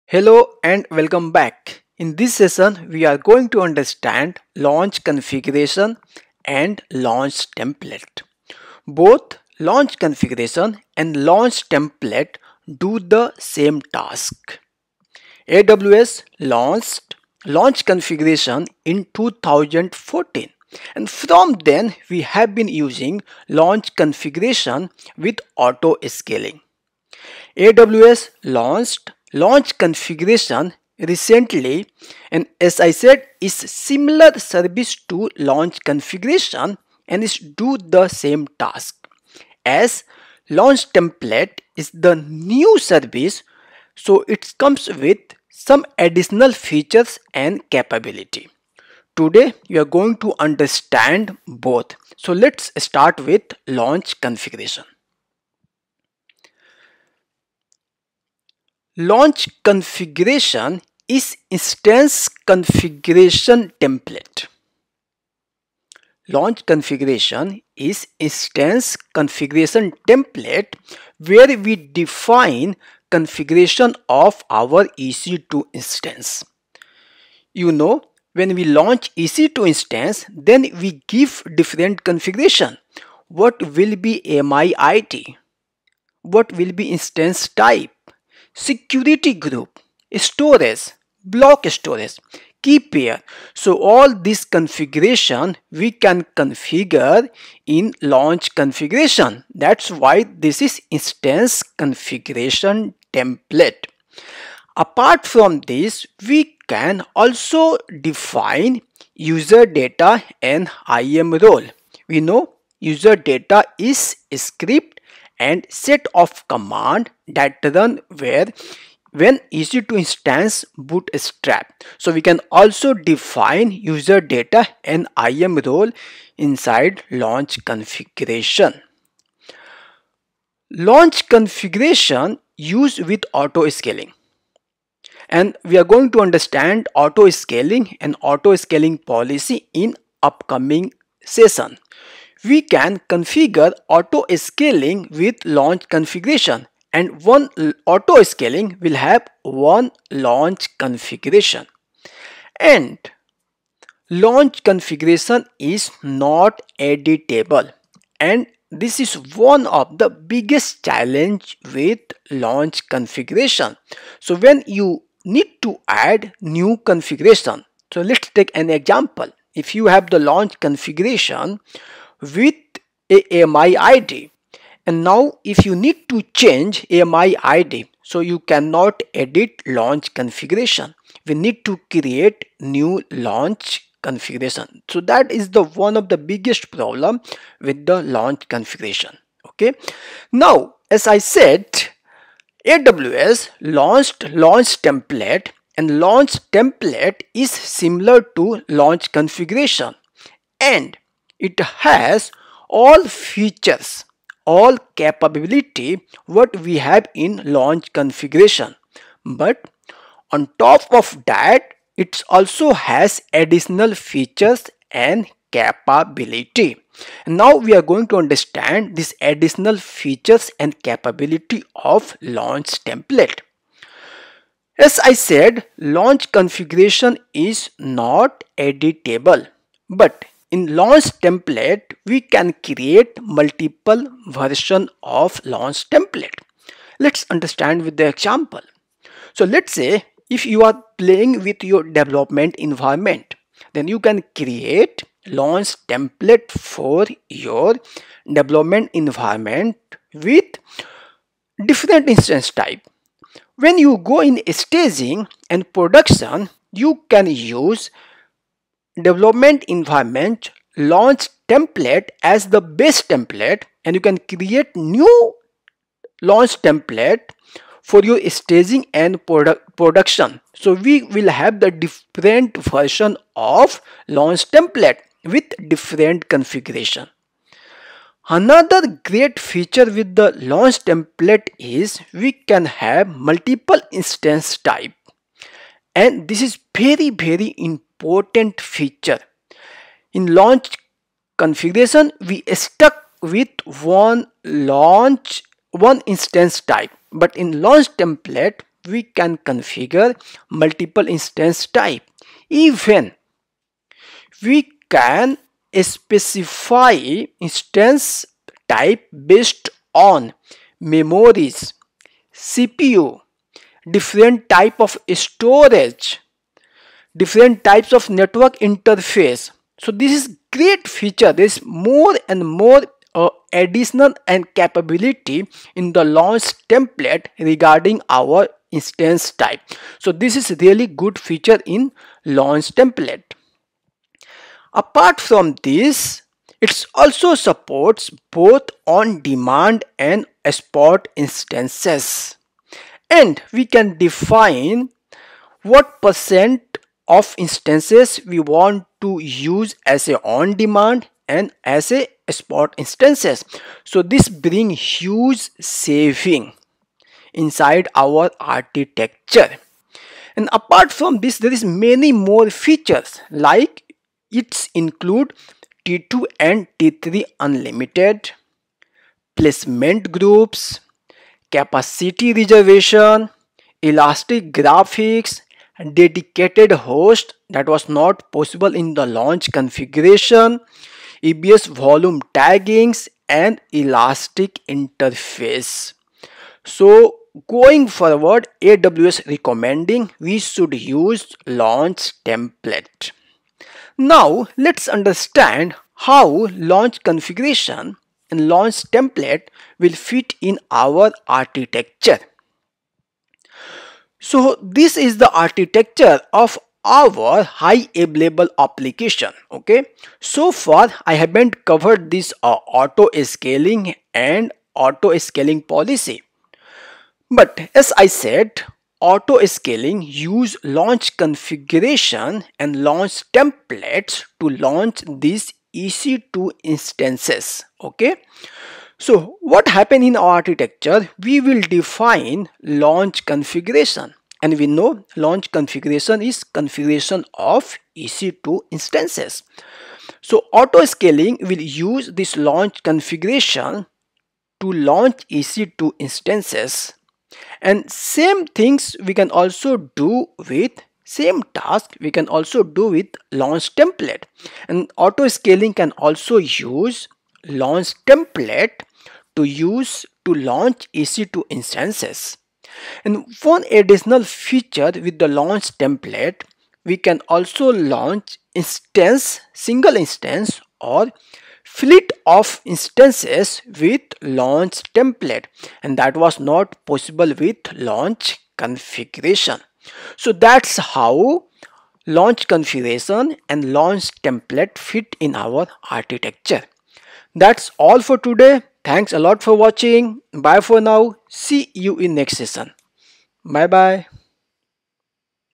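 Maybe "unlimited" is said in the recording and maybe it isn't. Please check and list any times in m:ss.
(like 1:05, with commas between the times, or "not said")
6:07.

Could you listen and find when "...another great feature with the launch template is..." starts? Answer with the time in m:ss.
4:38.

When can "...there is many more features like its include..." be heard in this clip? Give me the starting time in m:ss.
6:01.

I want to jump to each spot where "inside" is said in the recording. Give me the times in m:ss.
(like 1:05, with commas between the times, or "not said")
2:06, 5:57.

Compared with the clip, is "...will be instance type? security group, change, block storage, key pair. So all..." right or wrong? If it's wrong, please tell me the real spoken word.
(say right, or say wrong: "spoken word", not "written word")
wrong: "storage", not "change".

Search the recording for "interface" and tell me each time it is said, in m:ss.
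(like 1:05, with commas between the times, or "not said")
5:18, 6:24.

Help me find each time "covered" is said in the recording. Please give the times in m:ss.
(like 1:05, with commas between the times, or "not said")
6:51.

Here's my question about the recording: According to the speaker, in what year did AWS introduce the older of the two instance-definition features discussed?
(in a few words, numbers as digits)
2014.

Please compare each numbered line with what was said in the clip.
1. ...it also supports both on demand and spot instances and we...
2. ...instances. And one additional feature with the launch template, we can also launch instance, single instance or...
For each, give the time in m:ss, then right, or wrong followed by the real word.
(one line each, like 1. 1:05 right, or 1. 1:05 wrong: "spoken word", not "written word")
1. 5:36 right
2. 7:41 right.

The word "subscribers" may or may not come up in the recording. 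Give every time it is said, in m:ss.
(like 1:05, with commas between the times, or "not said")
not said.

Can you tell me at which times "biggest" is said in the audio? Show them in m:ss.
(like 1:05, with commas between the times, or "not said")
2:40, 3:06.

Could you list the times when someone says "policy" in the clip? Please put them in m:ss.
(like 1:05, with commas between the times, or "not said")
2:19, 6:55.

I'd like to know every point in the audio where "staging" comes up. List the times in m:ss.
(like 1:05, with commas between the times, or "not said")
4:14, 4:28.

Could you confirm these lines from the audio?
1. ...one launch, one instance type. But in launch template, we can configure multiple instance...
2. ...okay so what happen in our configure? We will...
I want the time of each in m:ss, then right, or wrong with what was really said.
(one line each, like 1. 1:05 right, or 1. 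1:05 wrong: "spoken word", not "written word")
1. 4:53 right
2. 7:07 wrong: "architecture", not "configure".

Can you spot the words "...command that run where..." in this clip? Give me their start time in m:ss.
1:56.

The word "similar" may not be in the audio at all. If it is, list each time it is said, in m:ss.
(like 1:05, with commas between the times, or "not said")
0:33, 3:17.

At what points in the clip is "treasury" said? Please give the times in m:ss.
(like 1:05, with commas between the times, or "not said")
not said.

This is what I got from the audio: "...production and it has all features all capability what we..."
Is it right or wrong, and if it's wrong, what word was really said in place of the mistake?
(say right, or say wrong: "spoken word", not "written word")
wrong: "configuration", not "production".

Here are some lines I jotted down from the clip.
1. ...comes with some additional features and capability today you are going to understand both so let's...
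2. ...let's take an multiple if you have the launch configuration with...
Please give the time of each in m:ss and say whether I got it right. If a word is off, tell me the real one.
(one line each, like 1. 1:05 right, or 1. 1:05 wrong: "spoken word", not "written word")
1. 0:44 right
2. 2:48 wrong: "example", not "multiple".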